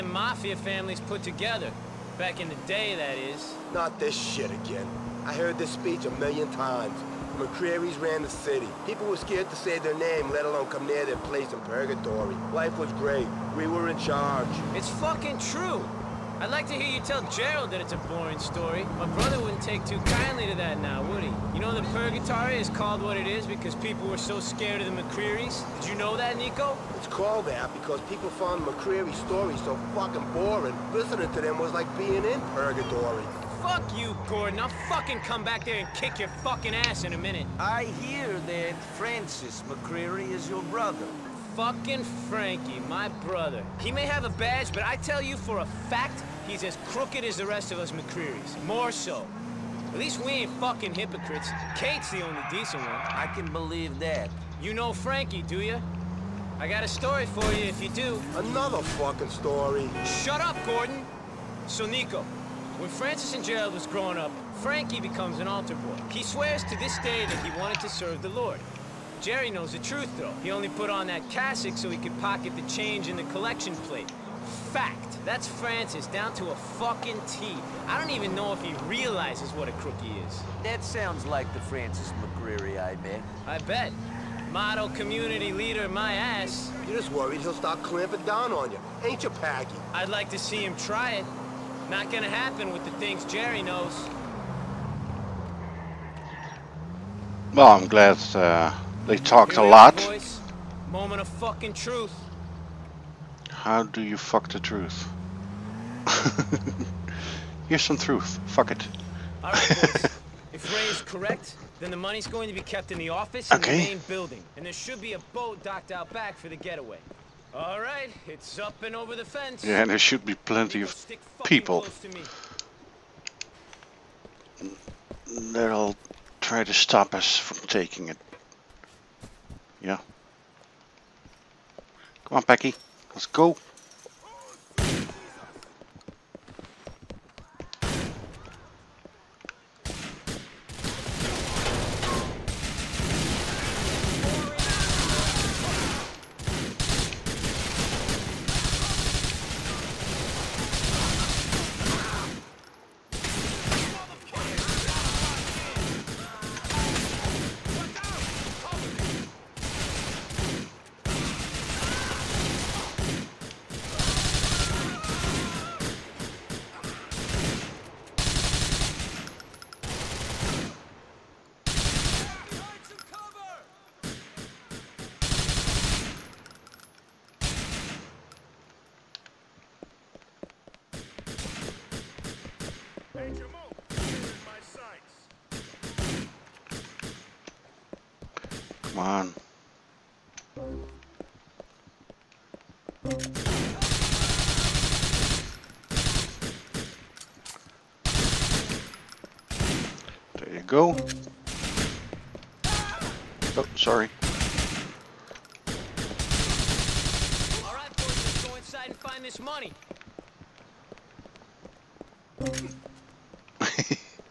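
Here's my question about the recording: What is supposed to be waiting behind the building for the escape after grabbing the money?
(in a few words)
a boat.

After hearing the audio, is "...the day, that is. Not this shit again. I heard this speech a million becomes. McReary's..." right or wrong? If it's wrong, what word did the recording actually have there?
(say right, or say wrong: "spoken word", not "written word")
wrong: "times", not "becomes".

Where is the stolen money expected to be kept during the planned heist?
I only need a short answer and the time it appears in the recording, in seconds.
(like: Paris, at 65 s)
in the office, at 113 s.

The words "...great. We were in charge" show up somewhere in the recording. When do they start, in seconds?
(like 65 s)
12 s.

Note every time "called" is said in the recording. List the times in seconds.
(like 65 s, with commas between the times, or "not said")
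22 s, 27 s.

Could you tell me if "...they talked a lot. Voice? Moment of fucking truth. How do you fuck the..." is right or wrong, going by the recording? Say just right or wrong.
right.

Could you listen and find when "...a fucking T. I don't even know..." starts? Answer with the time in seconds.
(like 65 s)
76 s.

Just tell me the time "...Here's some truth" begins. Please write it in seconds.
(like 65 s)
107 s.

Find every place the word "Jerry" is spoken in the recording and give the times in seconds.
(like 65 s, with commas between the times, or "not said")
69 s, 93 s.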